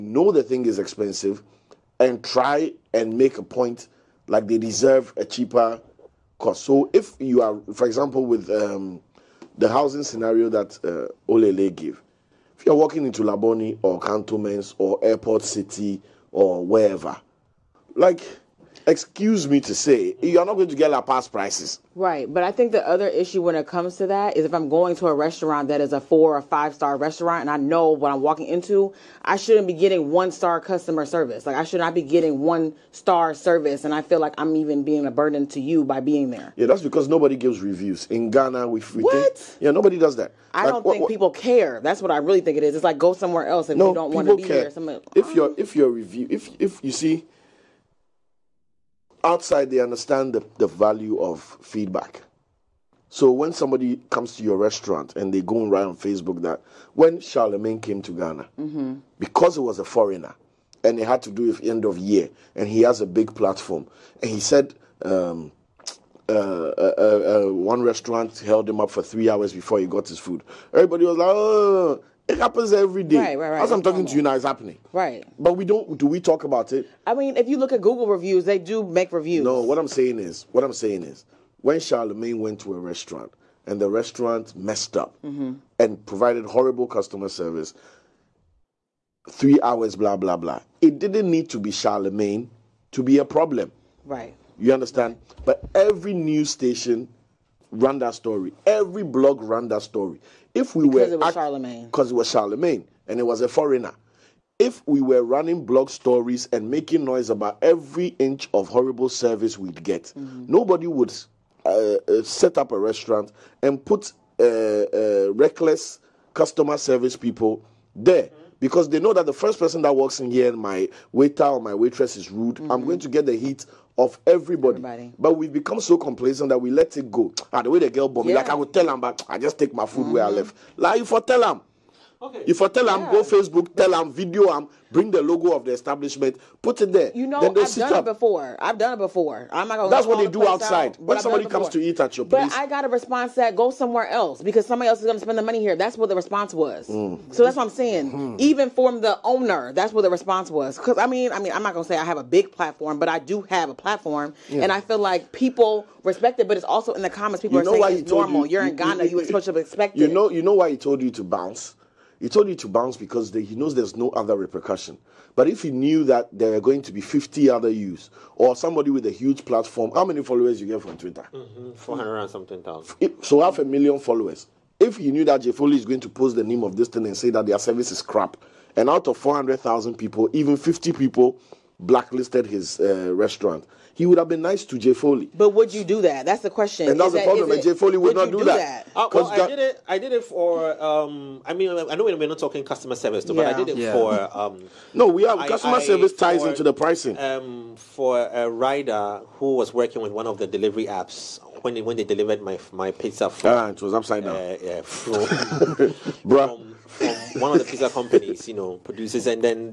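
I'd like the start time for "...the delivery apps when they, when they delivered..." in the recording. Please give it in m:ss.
3:20.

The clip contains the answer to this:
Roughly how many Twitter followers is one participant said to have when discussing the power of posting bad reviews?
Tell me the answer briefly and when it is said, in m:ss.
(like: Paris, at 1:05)
400,000, at 2:51.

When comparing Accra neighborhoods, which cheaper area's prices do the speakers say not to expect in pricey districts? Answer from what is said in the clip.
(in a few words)
Lapaz.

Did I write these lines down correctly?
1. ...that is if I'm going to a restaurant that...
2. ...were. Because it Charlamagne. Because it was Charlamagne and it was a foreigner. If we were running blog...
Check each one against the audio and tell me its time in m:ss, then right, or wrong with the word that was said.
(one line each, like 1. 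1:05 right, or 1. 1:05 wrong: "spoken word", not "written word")
1. 0:24 right
2. 1:41 right.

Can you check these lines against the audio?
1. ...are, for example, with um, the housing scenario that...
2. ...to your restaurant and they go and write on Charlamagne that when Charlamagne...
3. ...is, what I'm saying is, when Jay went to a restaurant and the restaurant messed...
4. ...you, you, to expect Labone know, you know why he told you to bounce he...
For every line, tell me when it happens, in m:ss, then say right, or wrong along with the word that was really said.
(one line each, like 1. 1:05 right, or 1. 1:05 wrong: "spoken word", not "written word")
1. 0:07 right
2. 0:54 wrong: "Facebook", not "Charlamagne"
3. 1:20 wrong: "Charlamagne", not "Jay"
4. 2:39 wrong: "You", not "Labone".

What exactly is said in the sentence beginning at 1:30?
It didn't need to be Charlamagne to be a problem.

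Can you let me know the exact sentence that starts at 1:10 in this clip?
Everybody was like, oh, it happens every day.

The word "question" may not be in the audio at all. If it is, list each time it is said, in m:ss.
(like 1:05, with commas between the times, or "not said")
3:06.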